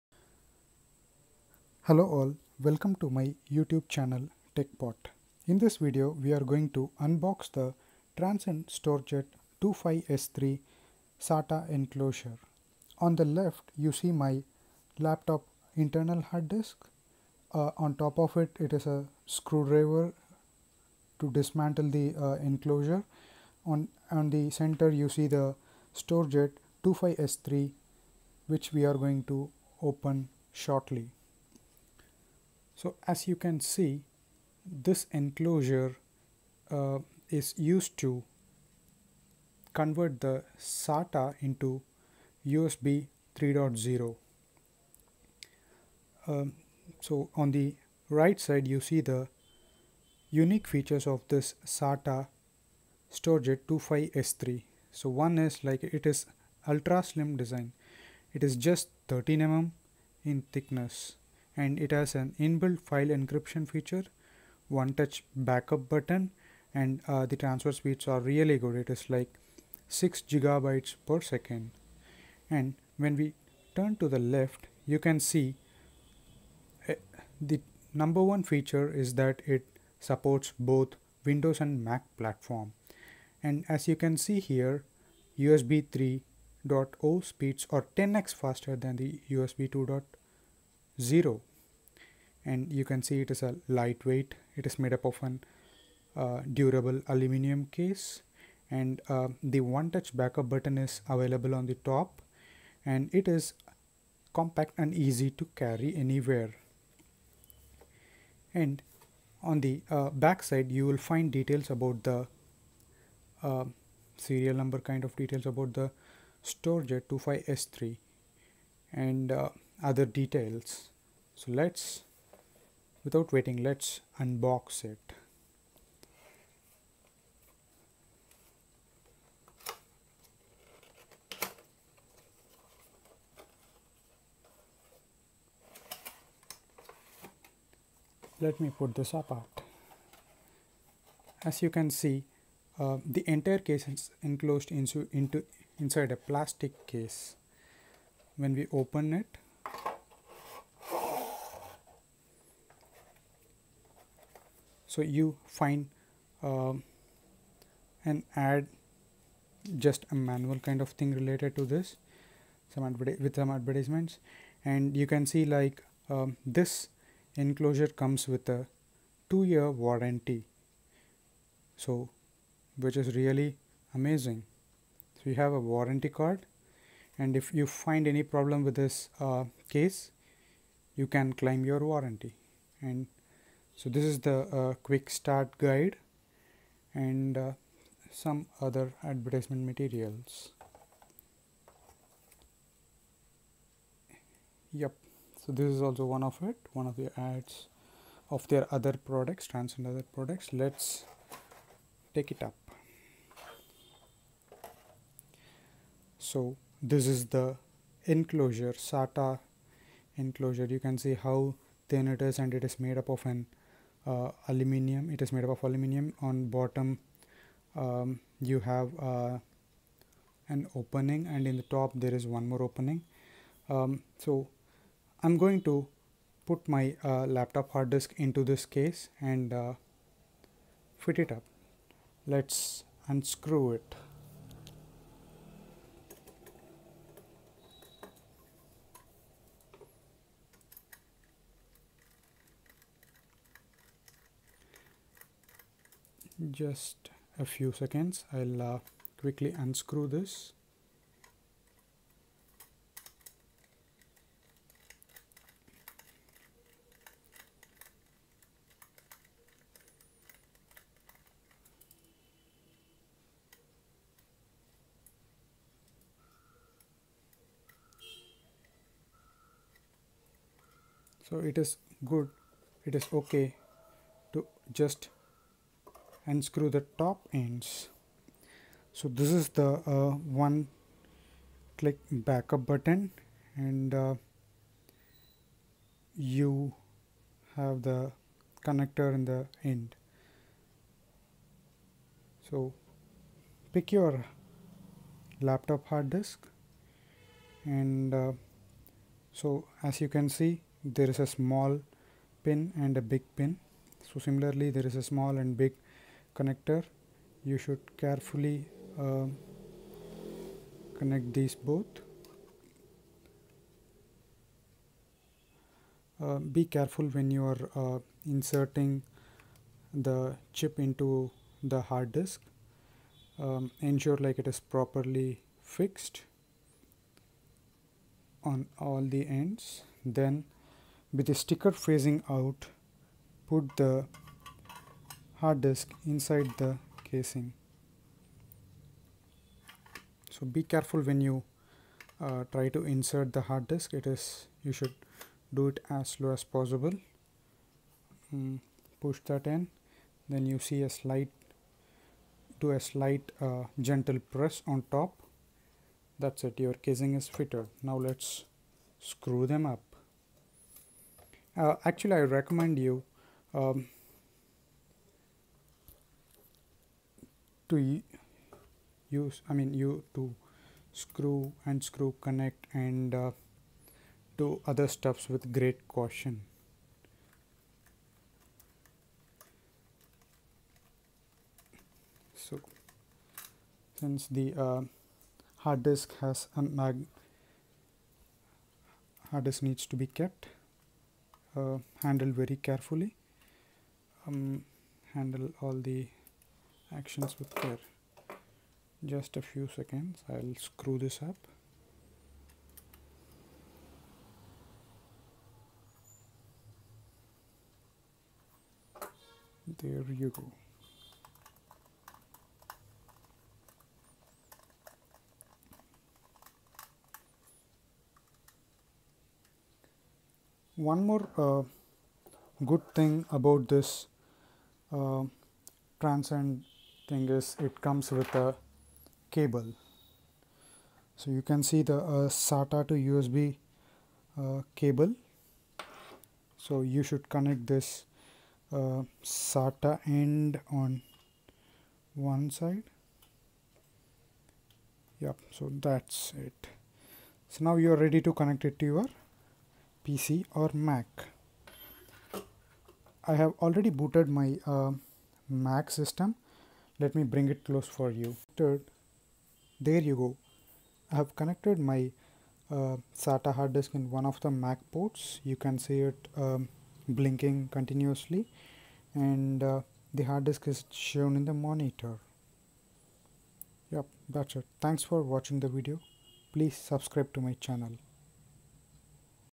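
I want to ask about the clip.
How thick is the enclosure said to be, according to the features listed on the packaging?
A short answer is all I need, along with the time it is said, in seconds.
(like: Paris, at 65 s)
13 mm, at 59 s.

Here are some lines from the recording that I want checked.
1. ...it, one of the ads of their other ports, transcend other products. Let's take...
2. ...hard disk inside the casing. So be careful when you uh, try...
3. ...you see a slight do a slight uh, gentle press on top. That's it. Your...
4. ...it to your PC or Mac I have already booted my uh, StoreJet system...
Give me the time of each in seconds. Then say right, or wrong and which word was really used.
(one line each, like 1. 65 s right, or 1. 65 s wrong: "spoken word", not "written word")
1. 196 s wrong: "products", not "ports"
2. 335 s right
3. 350 s right
4. 448 s wrong: "Mac", not "StoreJet".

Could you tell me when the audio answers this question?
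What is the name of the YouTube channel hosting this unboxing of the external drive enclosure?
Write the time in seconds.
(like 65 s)
4 s.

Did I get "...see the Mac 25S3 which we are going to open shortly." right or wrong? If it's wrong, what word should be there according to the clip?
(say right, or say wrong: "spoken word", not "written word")
wrong: "StoreJet", not "Mac".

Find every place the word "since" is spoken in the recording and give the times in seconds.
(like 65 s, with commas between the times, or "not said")
383 s.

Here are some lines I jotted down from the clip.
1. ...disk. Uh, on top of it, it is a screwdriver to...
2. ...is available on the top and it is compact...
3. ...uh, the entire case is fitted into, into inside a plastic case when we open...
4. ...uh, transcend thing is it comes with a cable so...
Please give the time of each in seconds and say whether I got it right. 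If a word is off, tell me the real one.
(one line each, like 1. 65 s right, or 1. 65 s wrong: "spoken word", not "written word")
1. 16 s right
2. 100 s right
3. 142 s wrong: "enclosed", not "fitted"
4. 424 s right.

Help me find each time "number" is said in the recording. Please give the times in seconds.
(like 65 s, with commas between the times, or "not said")
77 s, 114 s.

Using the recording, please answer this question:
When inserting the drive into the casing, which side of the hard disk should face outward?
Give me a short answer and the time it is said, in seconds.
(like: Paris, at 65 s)
The sticker, at 331 s.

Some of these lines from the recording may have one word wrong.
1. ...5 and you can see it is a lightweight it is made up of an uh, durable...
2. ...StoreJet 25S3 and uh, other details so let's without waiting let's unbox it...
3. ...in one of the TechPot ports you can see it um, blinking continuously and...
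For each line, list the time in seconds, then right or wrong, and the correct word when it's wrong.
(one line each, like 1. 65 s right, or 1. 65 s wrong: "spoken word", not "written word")
1. 90 s wrong: "0", not "5"
2. 116 s right
3. 463 s wrong: "Mac", not "TechPot".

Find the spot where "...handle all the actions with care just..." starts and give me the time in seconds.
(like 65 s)
395 s.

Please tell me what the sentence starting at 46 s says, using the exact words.
Um, so on the right side you see the unique features of this SATA StoreJet 25S3.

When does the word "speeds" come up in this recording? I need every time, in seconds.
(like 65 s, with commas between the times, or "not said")
67 s, 87 s.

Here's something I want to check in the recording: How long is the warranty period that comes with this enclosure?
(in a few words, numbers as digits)
2 years.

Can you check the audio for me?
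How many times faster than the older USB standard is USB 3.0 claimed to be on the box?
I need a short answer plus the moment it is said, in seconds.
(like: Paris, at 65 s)
10x, at 87 s.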